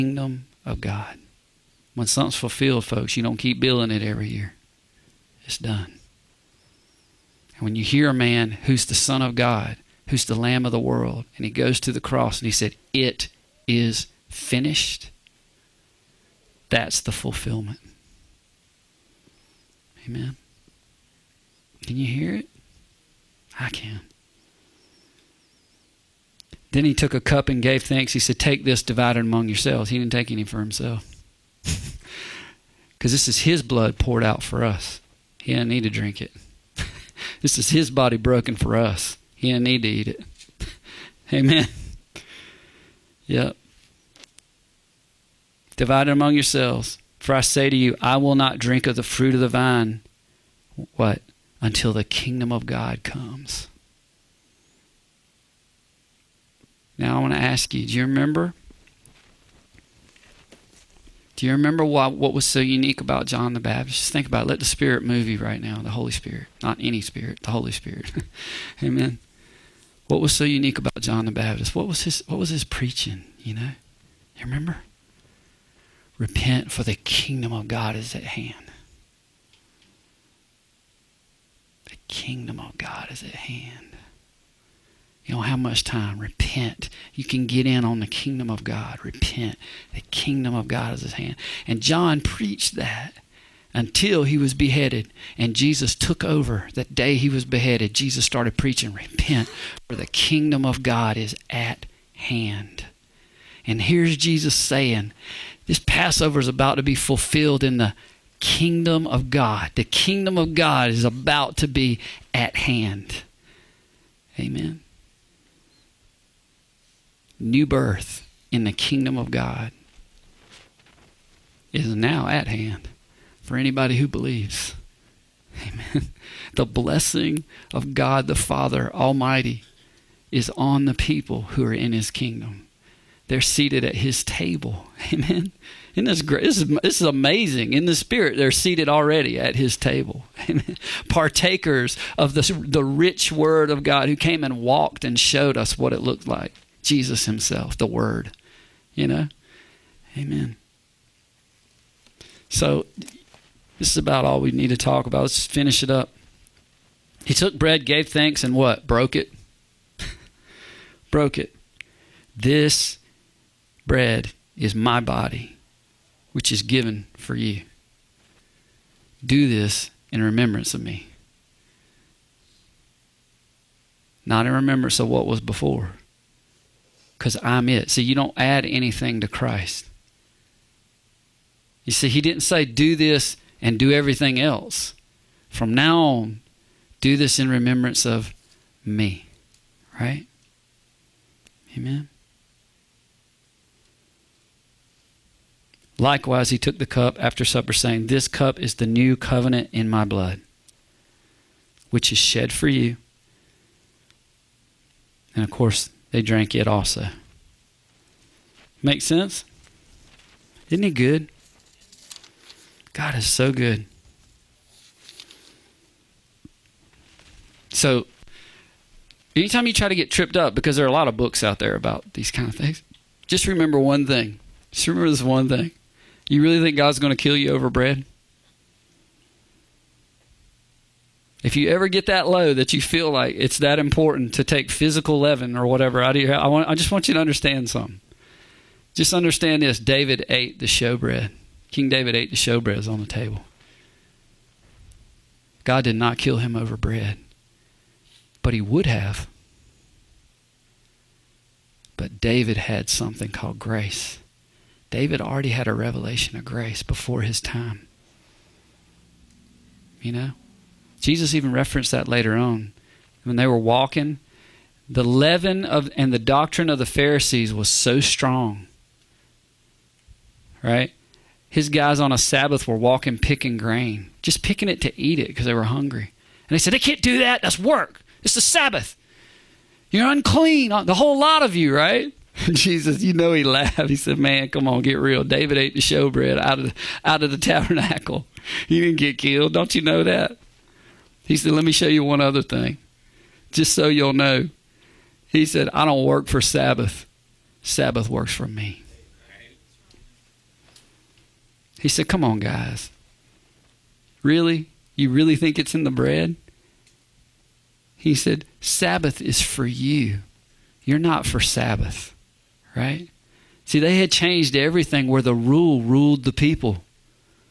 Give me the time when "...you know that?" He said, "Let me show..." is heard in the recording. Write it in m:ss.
4:49.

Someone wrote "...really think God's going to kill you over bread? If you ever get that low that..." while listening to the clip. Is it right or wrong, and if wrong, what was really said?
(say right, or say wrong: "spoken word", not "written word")
right.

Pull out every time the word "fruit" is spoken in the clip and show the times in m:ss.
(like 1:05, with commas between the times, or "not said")
0:49.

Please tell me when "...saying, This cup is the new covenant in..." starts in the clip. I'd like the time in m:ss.
3:17.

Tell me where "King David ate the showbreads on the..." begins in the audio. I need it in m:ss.
4:01.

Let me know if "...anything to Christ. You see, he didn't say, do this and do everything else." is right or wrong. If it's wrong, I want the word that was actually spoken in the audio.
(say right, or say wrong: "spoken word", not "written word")
right.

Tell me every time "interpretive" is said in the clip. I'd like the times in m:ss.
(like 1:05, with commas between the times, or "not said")
not said.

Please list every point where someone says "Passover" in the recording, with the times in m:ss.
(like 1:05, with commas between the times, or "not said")
1:45.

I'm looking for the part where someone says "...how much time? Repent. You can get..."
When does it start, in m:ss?
1:25.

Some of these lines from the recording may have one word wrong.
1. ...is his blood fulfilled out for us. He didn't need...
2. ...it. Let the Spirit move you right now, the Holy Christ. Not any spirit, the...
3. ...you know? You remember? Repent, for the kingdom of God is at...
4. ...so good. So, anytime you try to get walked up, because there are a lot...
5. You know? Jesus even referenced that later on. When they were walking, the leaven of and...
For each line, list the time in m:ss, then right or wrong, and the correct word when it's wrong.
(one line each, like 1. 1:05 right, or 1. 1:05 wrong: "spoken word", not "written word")
1. 0:33 wrong: "poured", not "fulfilled"
2. 1:04 wrong: "Spirit", not "Christ"
3. 1:13 right
4. 3:33 wrong: "tripped", not "walked"
5. 4:20 right.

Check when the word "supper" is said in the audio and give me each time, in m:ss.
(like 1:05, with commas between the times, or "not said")
3:17.